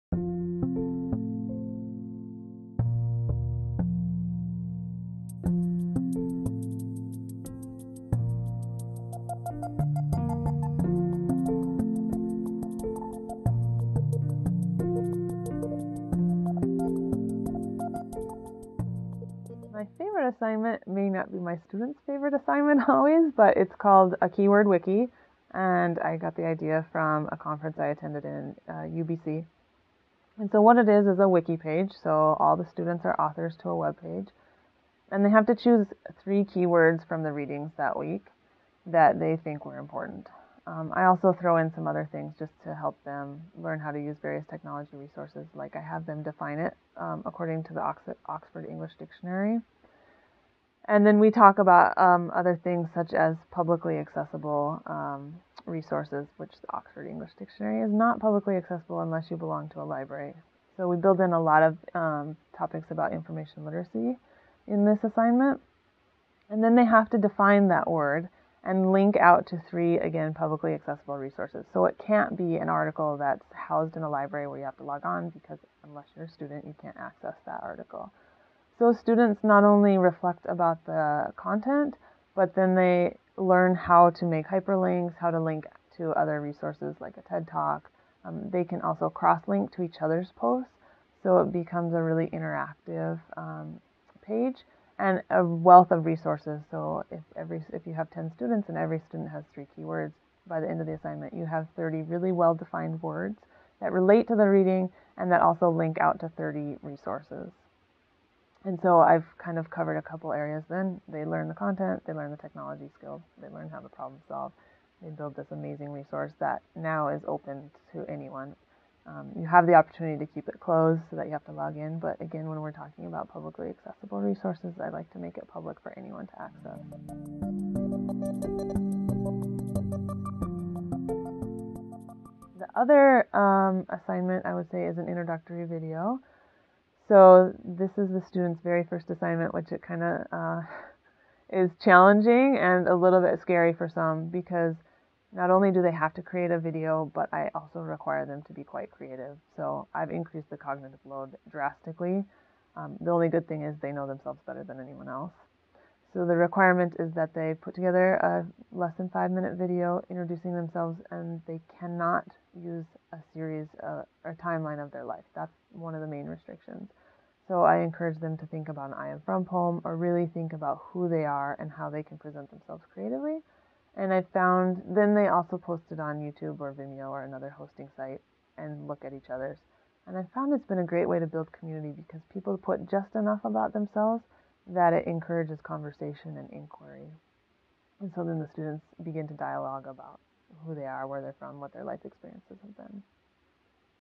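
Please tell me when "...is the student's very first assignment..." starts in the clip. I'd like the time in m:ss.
2:17.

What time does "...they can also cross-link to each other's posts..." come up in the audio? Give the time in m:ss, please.
1:28.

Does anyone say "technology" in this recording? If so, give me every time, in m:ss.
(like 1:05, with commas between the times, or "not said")
0:44, 1:52.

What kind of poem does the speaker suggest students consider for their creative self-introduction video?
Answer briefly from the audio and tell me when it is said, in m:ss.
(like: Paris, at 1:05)
I am from poem, at 2:48.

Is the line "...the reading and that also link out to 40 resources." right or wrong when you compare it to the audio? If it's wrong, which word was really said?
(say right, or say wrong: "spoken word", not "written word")
wrong: "30", not "40".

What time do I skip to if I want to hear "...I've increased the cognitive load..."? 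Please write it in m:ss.
2:29.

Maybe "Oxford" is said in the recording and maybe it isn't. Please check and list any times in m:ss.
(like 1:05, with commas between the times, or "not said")
0:47, 0:56.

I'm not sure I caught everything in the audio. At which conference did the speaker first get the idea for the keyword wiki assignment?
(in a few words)
UBC.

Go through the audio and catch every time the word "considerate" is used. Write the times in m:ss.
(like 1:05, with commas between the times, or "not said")
not said.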